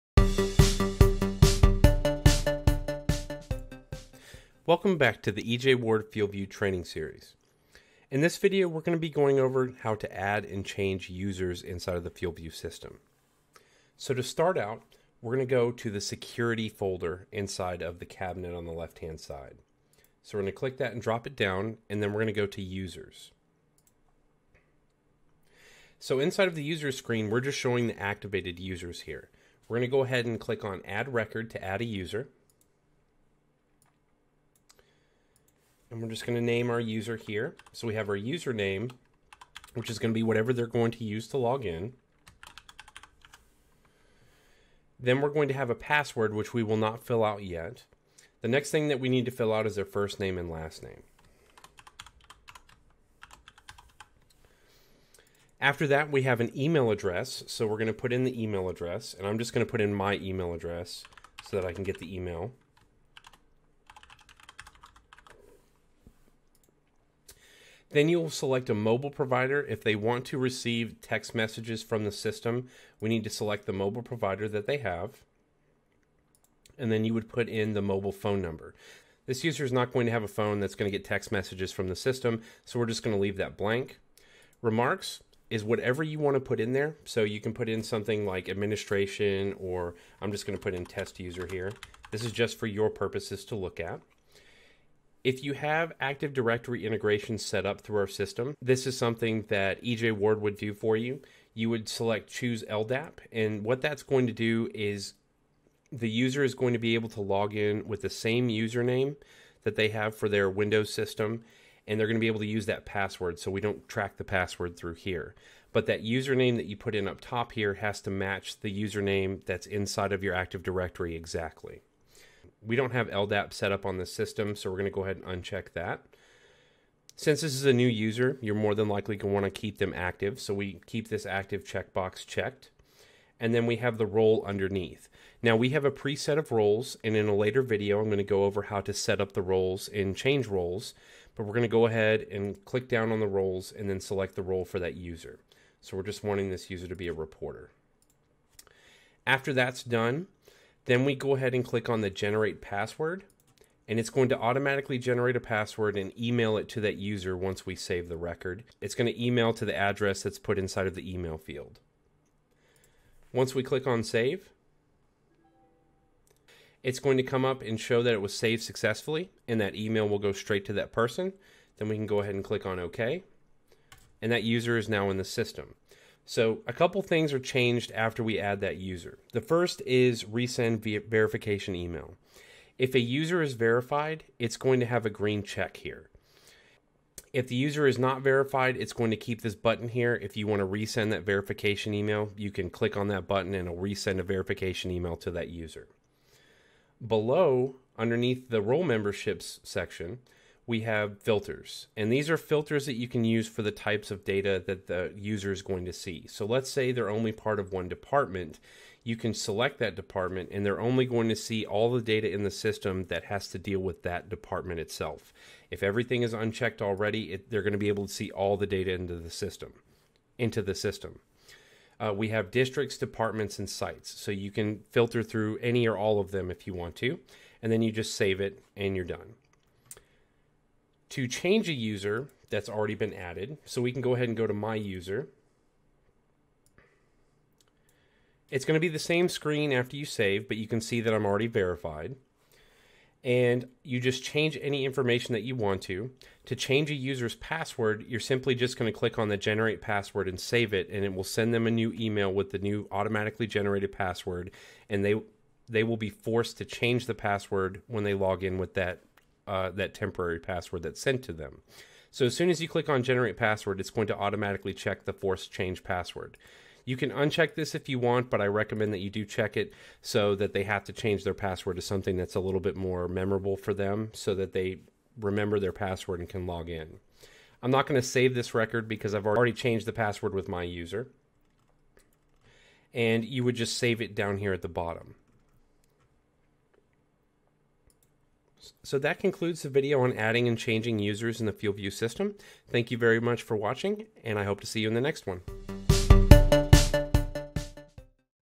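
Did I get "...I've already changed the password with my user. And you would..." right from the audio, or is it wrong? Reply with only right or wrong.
right.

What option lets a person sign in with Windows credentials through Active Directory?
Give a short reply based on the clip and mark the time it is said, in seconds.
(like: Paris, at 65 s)
Choose LDAP, at 102 s.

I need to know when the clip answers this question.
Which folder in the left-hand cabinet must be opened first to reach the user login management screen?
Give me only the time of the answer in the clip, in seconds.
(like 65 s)
15 s.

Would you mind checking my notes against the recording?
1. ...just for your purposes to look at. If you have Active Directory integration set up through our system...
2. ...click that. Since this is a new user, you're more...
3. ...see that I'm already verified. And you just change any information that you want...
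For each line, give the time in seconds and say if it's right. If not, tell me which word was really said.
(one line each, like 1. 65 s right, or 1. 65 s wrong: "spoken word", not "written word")
1. 92 s right
2. 125 s wrong: "uncheck", not "click"
3. 240 s right.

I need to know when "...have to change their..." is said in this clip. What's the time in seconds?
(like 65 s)
270 s.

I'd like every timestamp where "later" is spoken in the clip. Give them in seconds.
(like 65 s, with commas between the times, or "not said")
137 s.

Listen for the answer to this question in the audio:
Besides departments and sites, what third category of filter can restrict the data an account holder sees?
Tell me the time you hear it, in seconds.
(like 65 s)
222 s.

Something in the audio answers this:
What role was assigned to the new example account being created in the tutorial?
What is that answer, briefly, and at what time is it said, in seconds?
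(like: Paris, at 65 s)
Reporter, at 147 s.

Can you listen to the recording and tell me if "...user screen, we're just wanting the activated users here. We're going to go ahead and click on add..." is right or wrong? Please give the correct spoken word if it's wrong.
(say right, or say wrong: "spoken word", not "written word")
wrong: "showing", not "wanting".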